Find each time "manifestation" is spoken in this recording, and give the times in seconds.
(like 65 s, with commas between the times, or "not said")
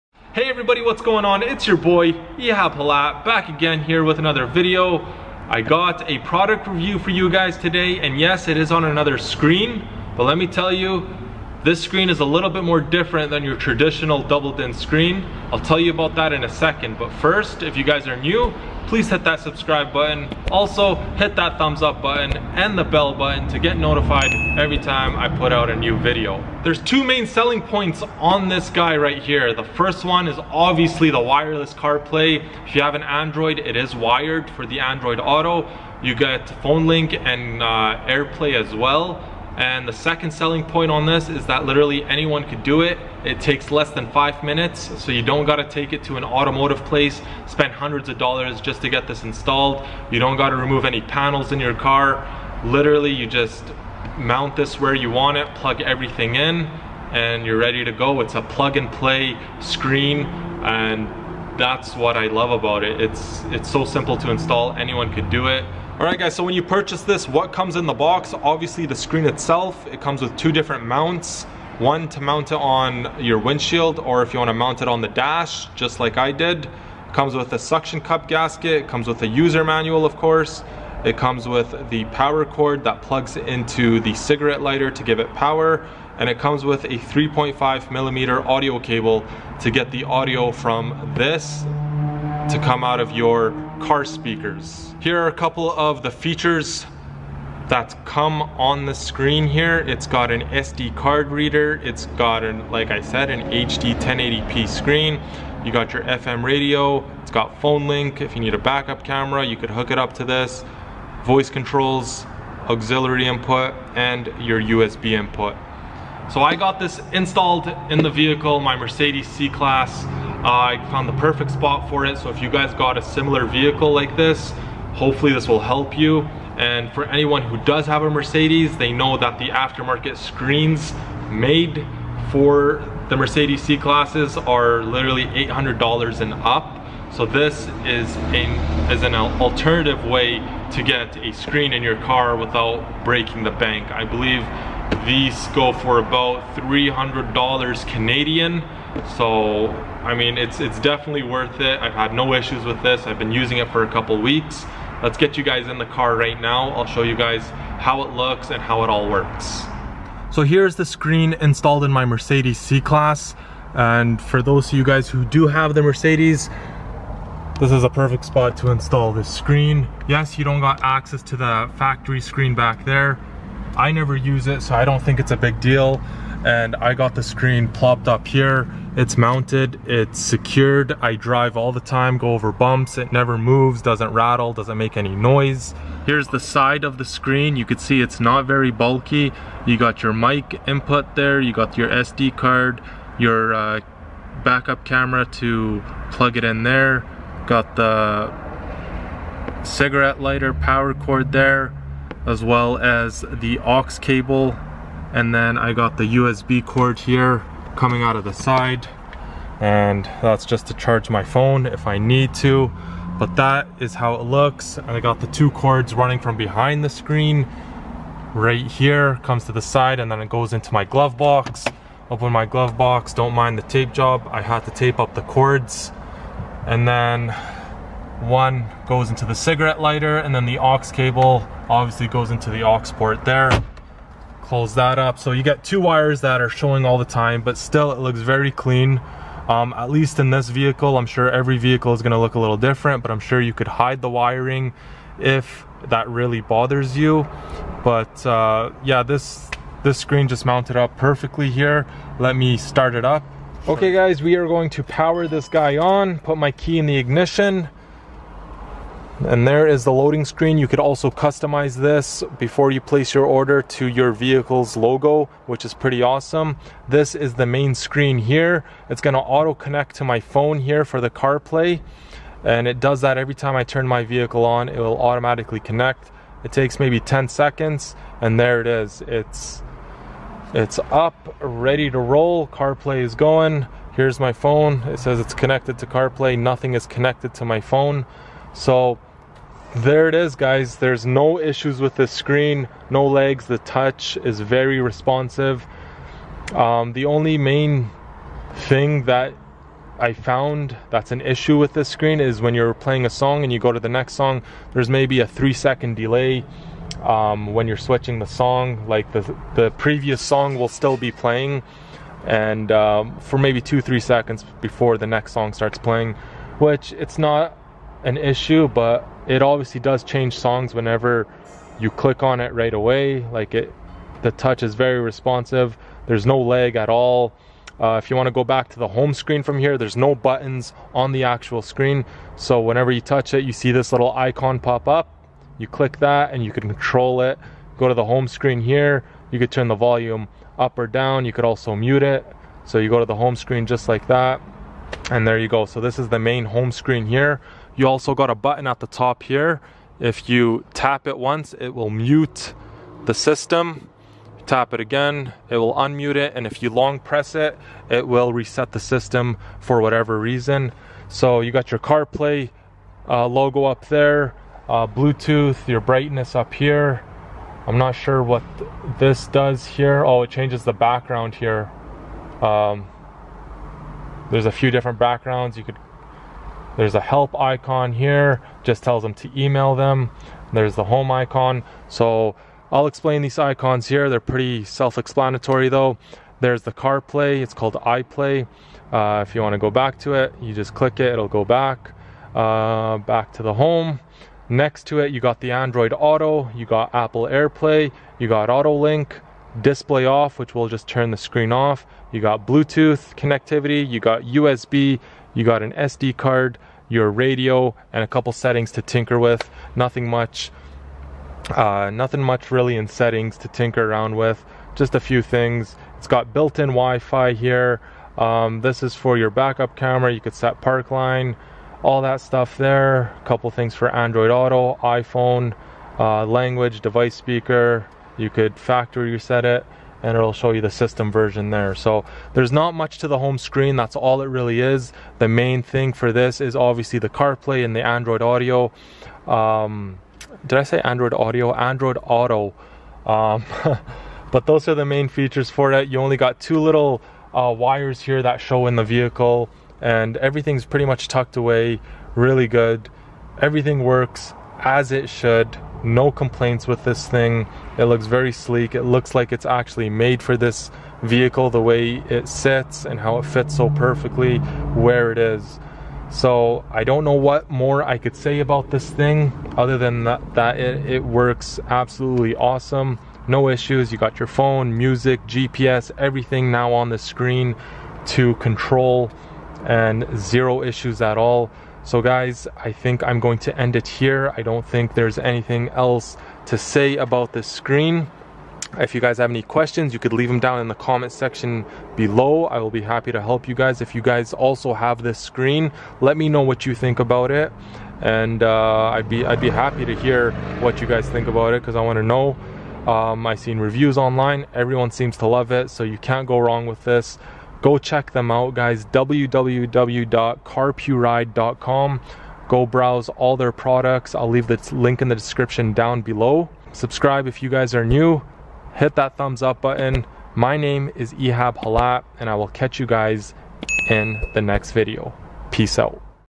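not said.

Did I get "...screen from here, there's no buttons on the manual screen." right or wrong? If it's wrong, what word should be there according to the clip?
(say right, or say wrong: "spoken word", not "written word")
wrong: "actual", not "manual".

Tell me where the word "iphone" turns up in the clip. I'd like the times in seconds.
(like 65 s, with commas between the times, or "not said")
424 s.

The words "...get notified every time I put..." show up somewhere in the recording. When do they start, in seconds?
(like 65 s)
23 s.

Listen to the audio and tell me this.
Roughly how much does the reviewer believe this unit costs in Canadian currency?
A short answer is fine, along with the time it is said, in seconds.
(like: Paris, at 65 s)
$300 Canadian, at 146 s.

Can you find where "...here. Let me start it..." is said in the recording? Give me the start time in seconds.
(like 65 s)
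251 s.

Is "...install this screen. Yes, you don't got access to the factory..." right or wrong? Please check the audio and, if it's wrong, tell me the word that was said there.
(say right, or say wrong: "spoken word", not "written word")
right.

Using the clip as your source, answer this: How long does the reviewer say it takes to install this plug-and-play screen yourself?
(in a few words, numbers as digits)
less than 5 minutes.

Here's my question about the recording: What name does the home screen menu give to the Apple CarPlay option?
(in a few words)
iPlay.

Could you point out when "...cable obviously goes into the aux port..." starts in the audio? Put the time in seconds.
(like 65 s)
230 s.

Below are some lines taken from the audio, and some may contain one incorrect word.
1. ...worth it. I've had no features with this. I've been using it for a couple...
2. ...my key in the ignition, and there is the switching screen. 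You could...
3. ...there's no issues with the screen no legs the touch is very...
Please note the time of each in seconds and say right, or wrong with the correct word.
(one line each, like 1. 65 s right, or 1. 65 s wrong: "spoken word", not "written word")
1. 151 s wrong: "issues", not "features"
2. 256 s wrong: "loading", not "switching"
3. 290 s right.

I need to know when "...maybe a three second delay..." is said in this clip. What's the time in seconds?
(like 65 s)
304 s.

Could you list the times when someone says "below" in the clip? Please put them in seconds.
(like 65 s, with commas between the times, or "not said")
491 s, 516 s.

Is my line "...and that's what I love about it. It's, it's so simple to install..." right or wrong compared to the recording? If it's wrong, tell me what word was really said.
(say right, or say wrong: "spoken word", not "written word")
right.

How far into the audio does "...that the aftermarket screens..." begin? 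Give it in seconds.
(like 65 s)
129 s.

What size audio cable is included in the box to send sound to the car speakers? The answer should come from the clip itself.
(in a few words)
3.5 millimeter.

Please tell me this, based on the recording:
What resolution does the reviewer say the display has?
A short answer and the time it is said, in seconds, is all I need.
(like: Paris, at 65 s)
1080p, at 103 s.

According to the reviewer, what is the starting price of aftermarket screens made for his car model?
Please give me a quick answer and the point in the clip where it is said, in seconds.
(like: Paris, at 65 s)
$800, at 135 s.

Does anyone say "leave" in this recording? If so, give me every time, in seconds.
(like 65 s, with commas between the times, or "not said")
490 s, 514 s.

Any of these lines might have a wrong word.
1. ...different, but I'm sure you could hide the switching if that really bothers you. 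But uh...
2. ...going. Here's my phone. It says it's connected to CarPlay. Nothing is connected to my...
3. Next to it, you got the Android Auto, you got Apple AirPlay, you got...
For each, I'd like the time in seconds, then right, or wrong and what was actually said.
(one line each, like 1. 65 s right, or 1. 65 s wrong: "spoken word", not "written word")
1. 242 s wrong: "wiring", not "switching"
2. 283 s right
3. 394 s right.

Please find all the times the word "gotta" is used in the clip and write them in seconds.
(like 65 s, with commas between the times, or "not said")
45 s, 50 s.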